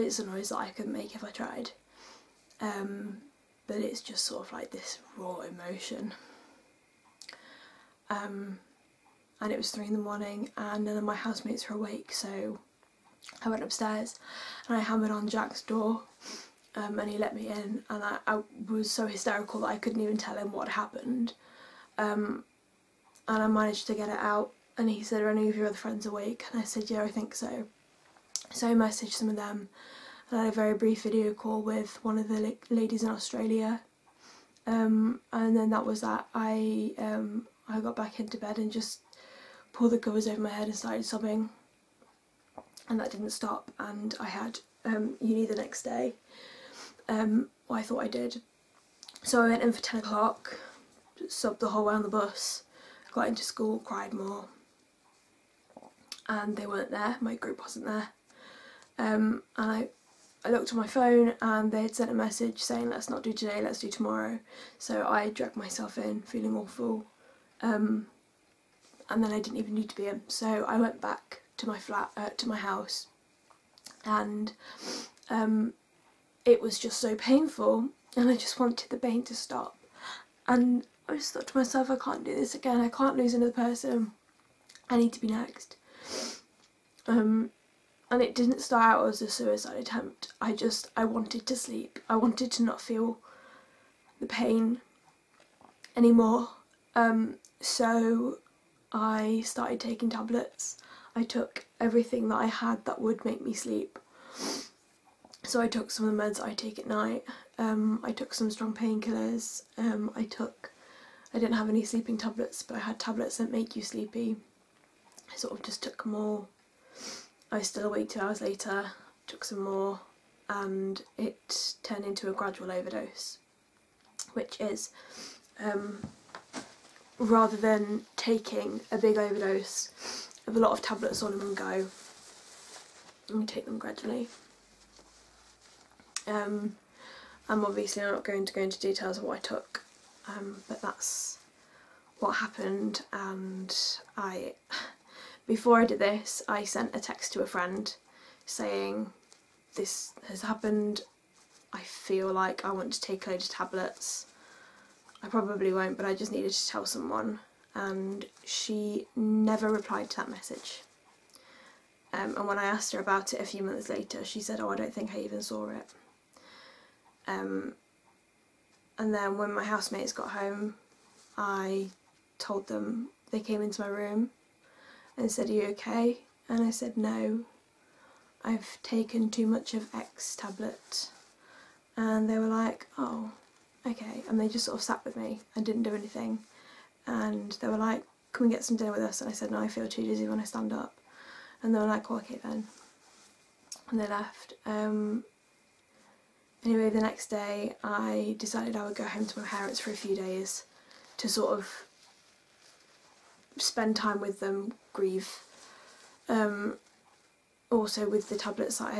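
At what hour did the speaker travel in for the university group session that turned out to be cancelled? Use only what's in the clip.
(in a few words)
10 o'clock.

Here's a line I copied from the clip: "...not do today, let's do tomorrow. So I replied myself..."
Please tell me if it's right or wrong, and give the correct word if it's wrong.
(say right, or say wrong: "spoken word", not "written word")
wrong: "dragged", not "replied".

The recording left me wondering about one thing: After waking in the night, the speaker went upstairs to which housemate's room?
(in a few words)
Jack.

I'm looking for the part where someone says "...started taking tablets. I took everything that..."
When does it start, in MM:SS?
01:39.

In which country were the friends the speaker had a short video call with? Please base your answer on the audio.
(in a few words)
Australia.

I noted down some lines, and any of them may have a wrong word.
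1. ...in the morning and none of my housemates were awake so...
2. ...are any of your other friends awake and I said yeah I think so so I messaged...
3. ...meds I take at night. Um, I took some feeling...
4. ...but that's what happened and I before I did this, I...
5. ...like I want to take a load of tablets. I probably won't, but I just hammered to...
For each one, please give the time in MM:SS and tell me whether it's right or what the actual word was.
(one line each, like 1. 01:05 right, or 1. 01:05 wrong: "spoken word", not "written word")
1. 00:09 right
2. 00:25 right
3. 01:46 wrong: "strong", not "feeling"
4. 02:20 right
5. 02:32 wrong: "needed", not "hammered".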